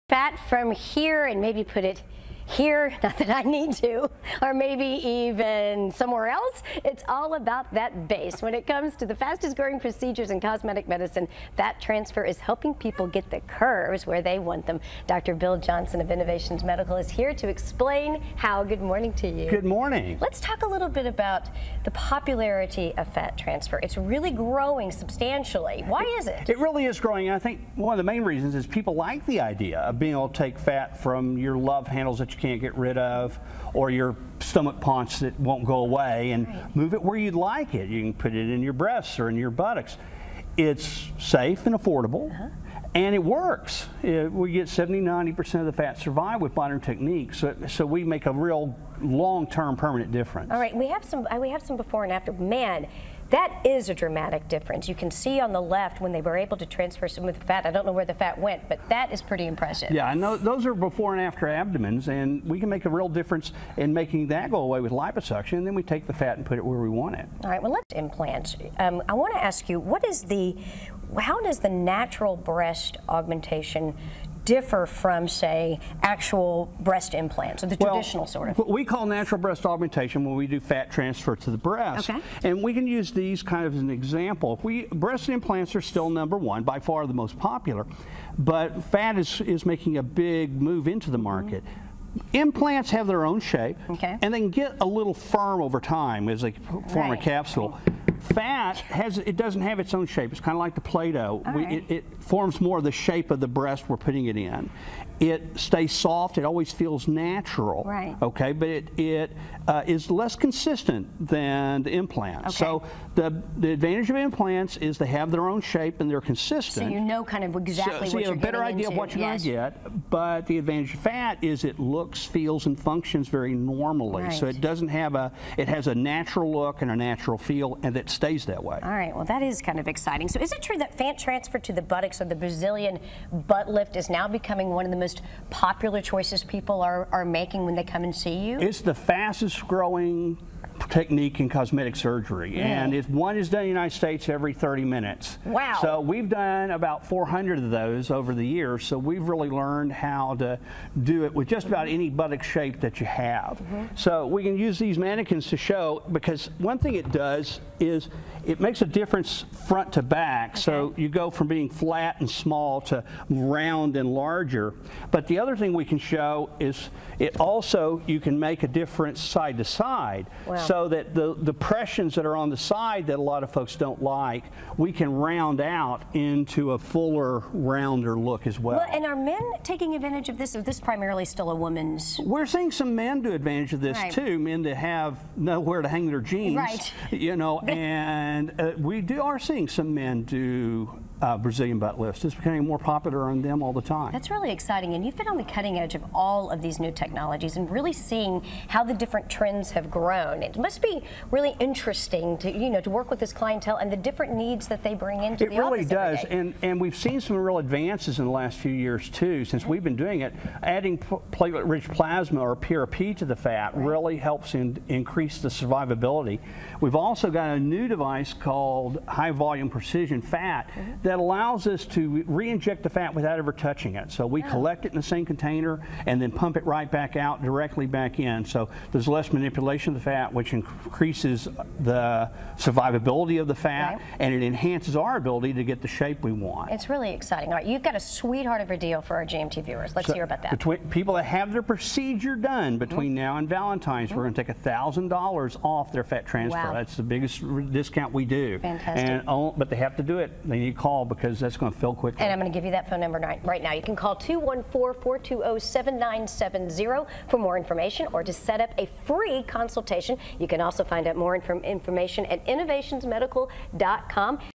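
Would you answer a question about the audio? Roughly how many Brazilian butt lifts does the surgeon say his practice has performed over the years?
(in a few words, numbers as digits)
400.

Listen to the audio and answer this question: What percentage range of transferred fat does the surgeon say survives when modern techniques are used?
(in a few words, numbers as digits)
70 to 90%.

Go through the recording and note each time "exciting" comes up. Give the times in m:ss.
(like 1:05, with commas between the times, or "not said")
2:09, 3:14, 3:57.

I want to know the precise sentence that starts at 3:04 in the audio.
too, men that have nowhere to hang their jeans.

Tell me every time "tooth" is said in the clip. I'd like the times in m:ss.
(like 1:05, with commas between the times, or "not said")
not said.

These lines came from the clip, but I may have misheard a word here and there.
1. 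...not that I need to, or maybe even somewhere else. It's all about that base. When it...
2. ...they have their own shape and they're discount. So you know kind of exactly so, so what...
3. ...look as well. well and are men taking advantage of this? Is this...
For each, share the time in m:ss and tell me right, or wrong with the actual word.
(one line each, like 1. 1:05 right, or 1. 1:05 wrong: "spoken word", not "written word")
1. 0:03 right
2. 1:54 wrong: "consistent", not "discount"
3. 2:58 right.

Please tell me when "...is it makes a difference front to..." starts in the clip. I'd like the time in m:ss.
2:37.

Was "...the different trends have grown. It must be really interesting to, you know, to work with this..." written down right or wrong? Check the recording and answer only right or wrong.
right.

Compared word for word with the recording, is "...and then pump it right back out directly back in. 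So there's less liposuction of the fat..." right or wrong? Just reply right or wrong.
wrong.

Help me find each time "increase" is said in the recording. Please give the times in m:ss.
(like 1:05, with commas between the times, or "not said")
3:34, 3:50.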